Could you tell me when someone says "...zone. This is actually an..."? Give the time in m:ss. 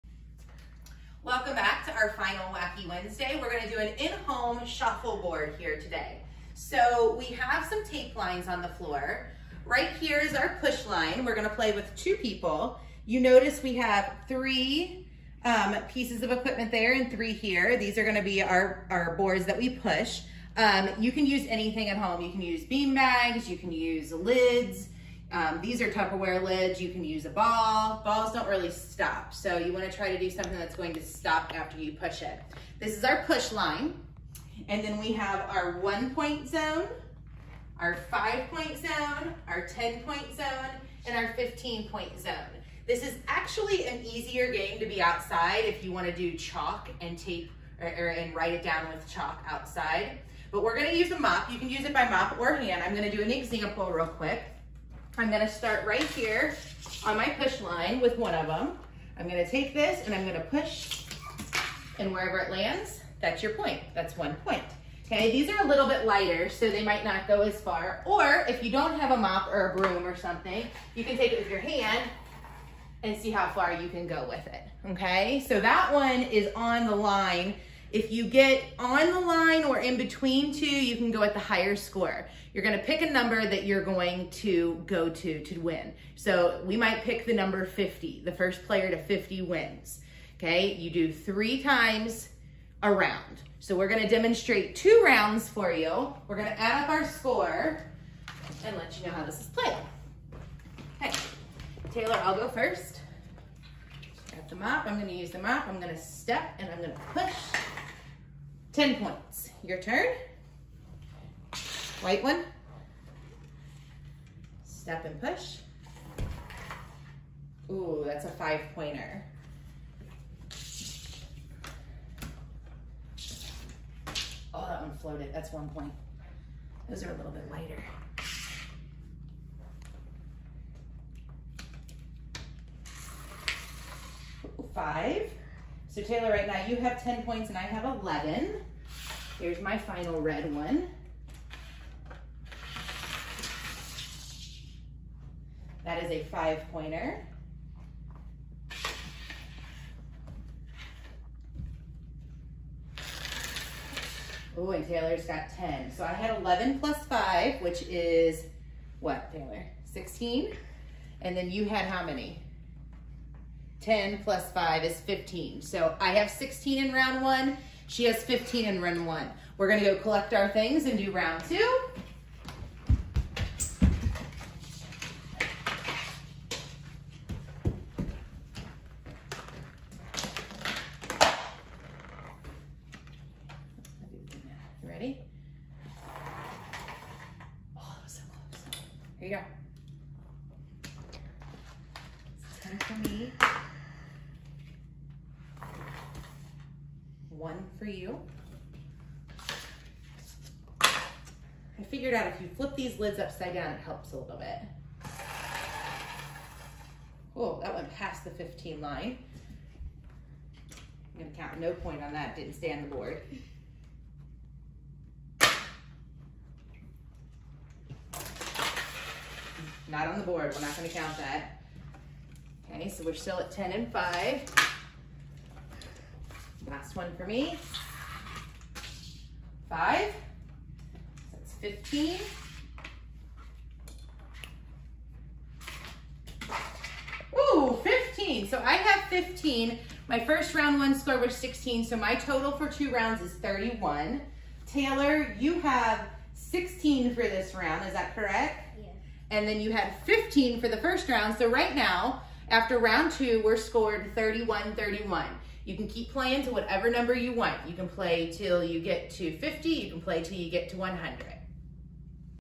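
0:42.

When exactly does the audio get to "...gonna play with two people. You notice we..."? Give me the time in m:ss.
0:11.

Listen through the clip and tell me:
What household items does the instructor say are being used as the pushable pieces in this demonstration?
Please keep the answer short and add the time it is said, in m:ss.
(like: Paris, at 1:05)
Tupperware lids, at 0:25.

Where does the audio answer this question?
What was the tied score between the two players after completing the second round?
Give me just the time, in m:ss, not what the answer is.
4:14.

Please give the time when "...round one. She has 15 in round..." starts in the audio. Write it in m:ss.
2:46.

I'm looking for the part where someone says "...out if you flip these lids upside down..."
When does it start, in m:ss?
3:22.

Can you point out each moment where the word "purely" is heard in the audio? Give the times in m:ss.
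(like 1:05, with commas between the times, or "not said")
not said.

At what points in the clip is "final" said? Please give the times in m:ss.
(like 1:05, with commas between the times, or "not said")
0:02, 2:19.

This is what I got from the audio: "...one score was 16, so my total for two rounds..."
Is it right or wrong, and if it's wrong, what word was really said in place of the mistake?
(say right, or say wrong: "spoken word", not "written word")
right.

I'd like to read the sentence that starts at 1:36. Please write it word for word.
We're gonna add up our score and let you know how this is played.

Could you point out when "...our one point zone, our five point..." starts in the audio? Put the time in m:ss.
0:35.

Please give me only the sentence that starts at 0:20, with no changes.
Um, you can use anything at home.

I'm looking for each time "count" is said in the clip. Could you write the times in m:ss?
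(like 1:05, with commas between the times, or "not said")
3:31, 3:40.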